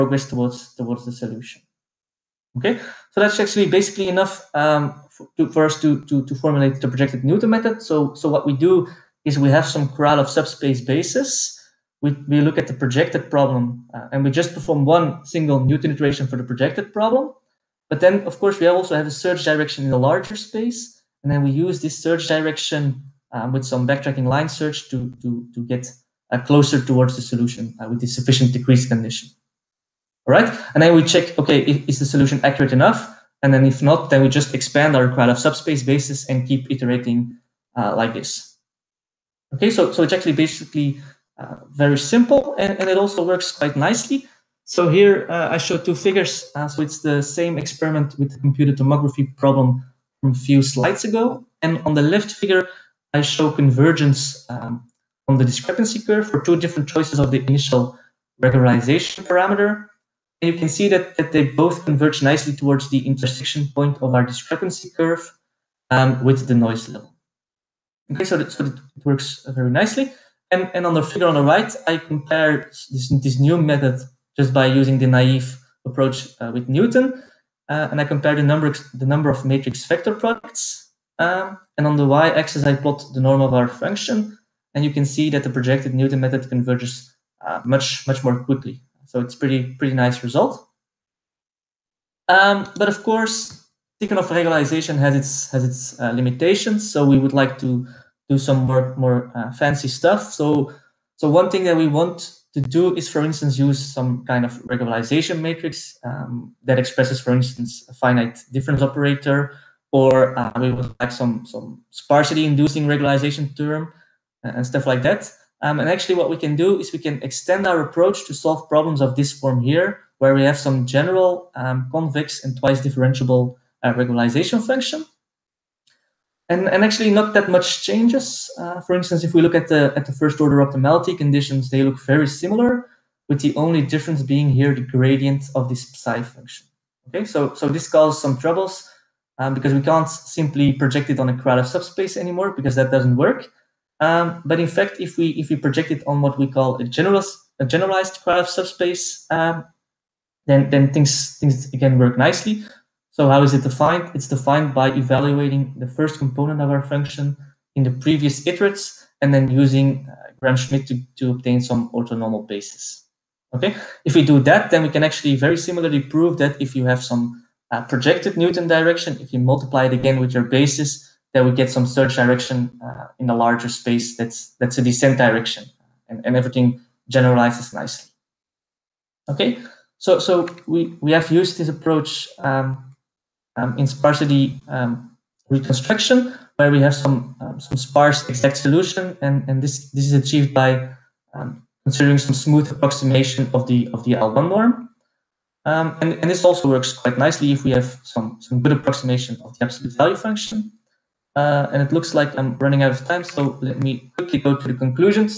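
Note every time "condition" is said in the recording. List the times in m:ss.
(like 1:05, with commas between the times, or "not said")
0:28, 2:11.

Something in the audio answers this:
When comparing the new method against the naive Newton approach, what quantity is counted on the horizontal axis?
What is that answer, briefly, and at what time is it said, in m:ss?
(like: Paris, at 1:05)
Matrix vector products, at 1:19.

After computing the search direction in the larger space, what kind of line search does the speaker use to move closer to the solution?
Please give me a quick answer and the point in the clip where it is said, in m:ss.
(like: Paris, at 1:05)
Backtracking line search, at 0:23.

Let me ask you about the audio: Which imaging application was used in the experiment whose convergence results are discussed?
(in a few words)
Computed tomography.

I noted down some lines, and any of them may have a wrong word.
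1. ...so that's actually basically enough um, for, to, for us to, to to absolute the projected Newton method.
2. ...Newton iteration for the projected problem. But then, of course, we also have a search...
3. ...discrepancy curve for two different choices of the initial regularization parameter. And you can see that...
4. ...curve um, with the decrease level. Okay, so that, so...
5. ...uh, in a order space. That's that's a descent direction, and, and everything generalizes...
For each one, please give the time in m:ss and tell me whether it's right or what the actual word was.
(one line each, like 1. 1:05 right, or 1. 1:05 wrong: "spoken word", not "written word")
1. 0:03 wrong: "formulate", not "absolute"
2. 0:15 right
3. 0:55 right
4. 1:04 wrong: "noise", not "decrease"
5. 2:52 wrong: "larger", not "order".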